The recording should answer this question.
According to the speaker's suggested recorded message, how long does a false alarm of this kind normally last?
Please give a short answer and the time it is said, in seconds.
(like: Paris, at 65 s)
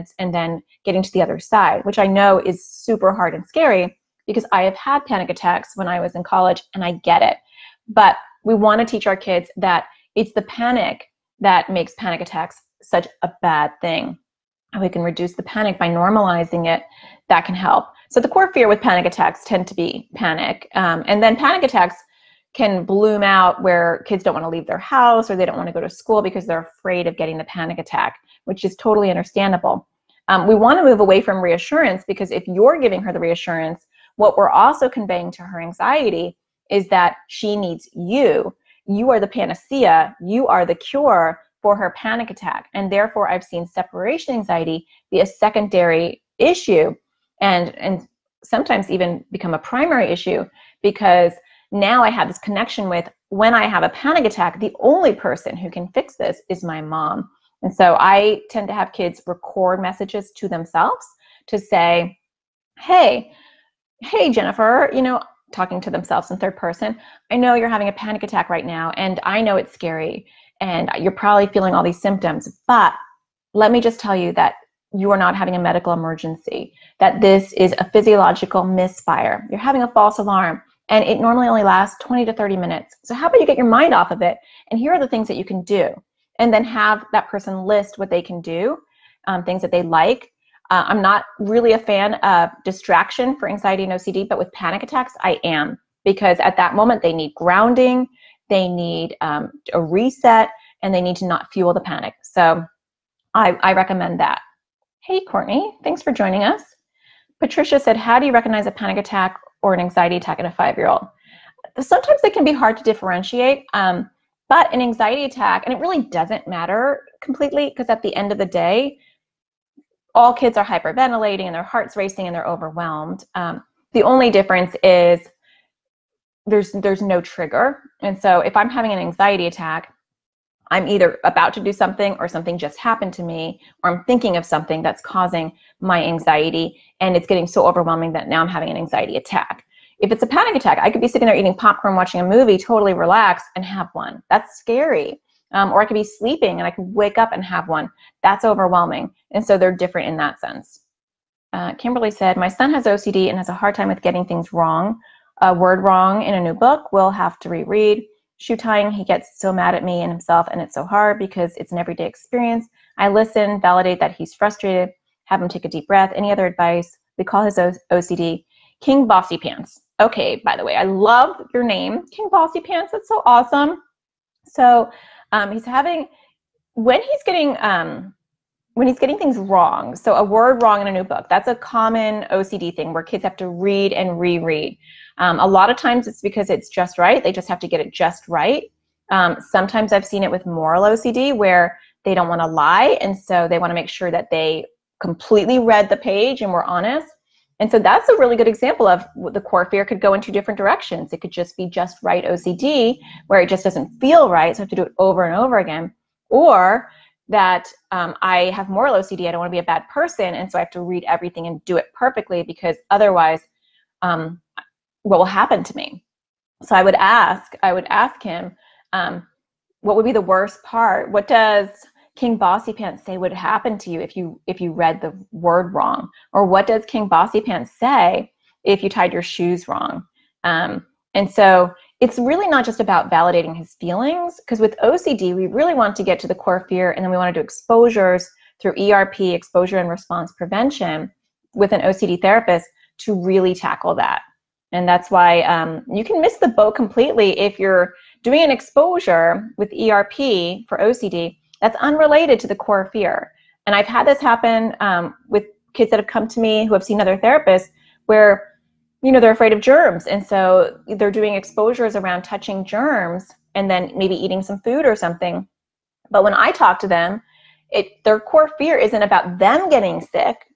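20 to 30 minutes, at 82 s.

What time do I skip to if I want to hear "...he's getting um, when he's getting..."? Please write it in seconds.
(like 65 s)
177 s.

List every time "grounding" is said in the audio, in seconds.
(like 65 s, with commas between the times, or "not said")
97 s.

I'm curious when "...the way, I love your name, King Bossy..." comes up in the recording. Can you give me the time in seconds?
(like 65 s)
170 s.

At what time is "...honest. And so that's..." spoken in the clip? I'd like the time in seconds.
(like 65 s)
196 s.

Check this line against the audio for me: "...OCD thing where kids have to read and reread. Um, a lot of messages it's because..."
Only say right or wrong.
wrong.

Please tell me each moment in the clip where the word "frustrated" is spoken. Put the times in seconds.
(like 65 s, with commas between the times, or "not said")
164 s.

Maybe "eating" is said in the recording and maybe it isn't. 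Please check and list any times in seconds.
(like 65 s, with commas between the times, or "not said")
141 s, 264 s.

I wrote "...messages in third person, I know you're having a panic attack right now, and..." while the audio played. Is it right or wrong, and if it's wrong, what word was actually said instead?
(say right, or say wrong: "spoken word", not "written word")
wrong: "themselves", not "messages".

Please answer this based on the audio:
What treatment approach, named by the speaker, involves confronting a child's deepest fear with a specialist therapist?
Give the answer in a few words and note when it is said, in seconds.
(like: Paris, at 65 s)
exposure and response prevention, at 239 s.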